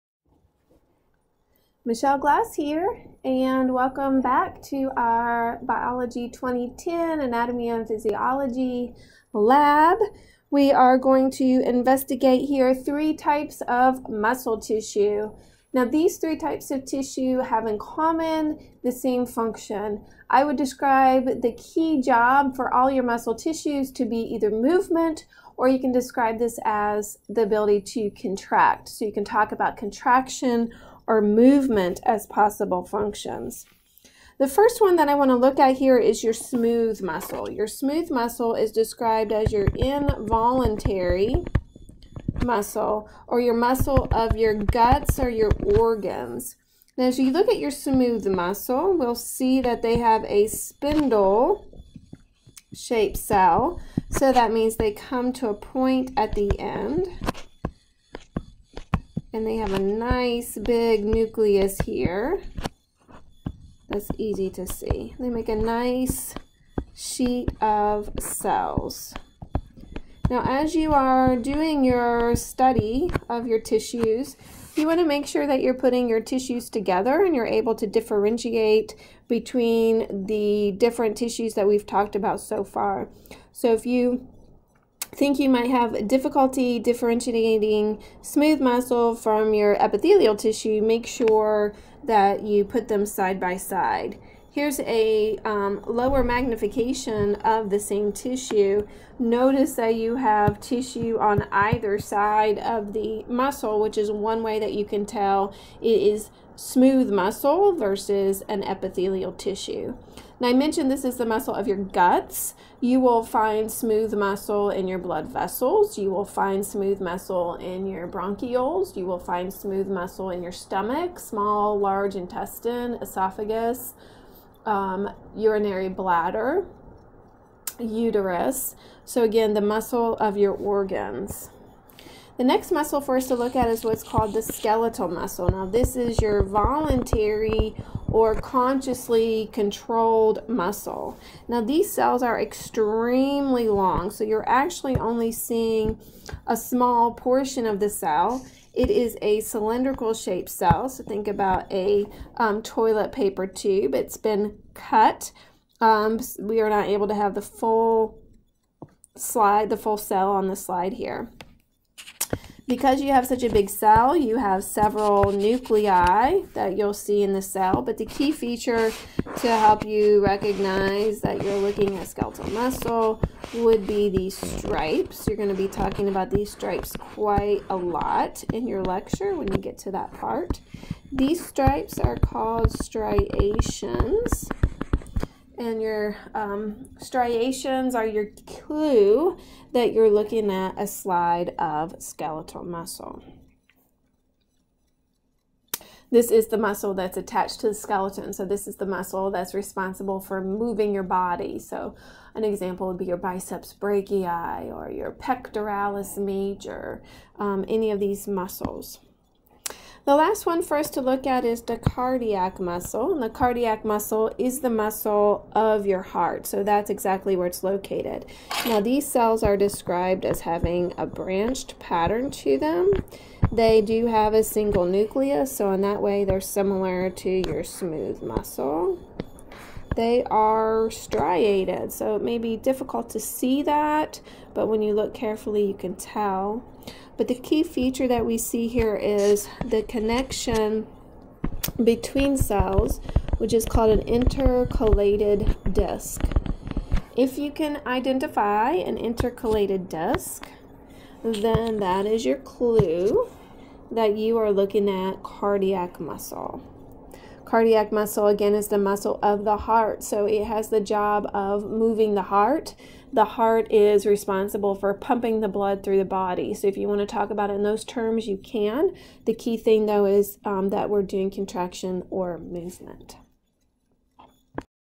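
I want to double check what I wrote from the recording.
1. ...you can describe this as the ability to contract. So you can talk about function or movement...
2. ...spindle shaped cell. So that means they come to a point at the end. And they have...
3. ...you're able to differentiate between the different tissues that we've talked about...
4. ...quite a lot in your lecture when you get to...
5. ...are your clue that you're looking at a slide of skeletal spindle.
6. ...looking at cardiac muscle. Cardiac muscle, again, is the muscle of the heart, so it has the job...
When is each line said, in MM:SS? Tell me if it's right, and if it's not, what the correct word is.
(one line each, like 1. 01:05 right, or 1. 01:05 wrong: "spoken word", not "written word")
1. 00:25 wrong: "contraction", not "function"
2. 00:50 right
3. 01:17 right
4. 02:56 right
5. 03:07 wrong: "muscle", not "spindle"
6. 04:14 right.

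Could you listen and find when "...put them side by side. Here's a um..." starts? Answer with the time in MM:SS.
01:32.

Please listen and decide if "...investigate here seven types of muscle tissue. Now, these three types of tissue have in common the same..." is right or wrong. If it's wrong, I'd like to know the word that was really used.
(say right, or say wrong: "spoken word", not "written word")
wrong: "three", not "seven".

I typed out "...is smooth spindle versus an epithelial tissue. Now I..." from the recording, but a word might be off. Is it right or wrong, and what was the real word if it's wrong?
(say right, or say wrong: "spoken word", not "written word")
wrong: "muscle", not "spindle".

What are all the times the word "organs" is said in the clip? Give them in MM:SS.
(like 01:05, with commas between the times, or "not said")
00:45, 02:10.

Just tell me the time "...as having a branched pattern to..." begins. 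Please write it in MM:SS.
03:40.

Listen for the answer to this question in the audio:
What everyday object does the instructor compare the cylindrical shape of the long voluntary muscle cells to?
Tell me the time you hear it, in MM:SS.
02:32.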